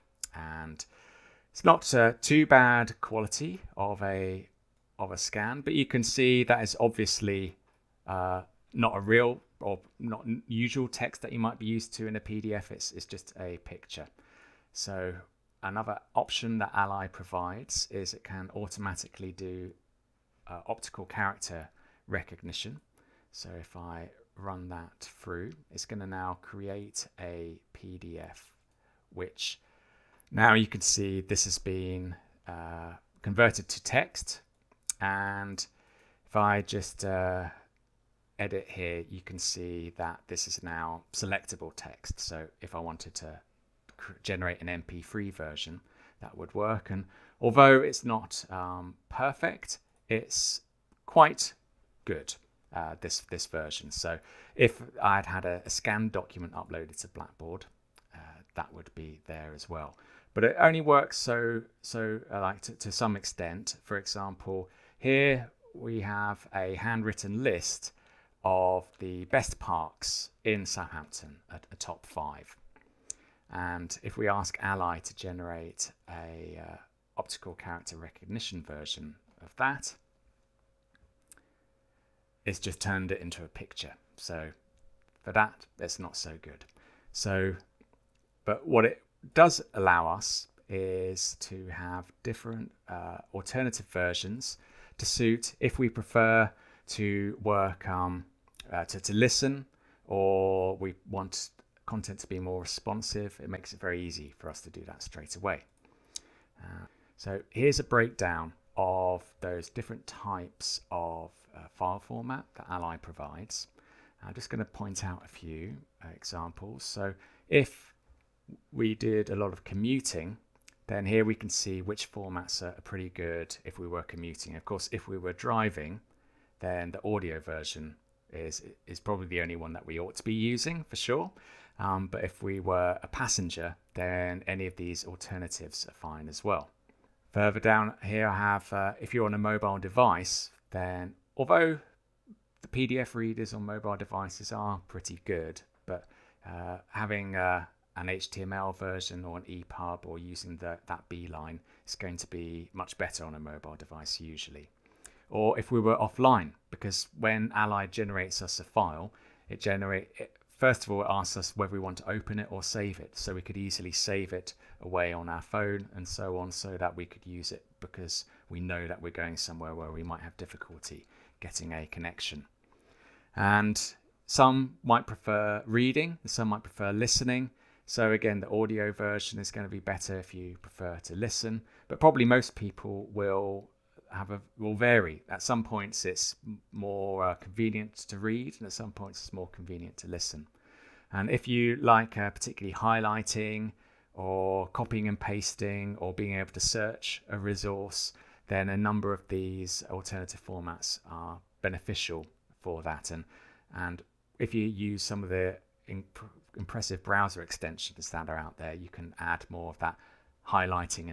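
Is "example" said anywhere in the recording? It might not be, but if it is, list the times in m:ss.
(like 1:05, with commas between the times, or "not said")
1:03, 1:56.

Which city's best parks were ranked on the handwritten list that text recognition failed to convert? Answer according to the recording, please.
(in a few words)
Southampton.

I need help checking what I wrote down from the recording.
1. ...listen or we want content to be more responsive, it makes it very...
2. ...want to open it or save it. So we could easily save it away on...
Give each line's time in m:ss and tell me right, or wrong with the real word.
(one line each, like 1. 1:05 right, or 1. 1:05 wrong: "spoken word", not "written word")
1. 1:39 right
2. 2:41 right.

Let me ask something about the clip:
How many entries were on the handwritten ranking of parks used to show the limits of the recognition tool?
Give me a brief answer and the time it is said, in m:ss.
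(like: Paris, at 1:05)
5, at 1:12.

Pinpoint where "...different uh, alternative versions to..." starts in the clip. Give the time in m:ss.
1:32.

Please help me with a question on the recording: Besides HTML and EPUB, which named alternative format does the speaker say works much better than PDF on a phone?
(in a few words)
Beeline.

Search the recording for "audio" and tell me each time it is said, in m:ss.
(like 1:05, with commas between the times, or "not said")
2:07, 2:58.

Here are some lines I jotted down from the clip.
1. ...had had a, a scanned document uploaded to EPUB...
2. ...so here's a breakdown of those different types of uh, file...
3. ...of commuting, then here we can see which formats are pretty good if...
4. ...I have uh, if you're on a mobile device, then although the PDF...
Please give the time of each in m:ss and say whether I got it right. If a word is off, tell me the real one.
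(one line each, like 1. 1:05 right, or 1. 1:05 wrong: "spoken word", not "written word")
1. 0:55 wrong: "Blackboard", not "EPUB"
2. 1:47 right
3. 1:59 right
4. 2:18 right.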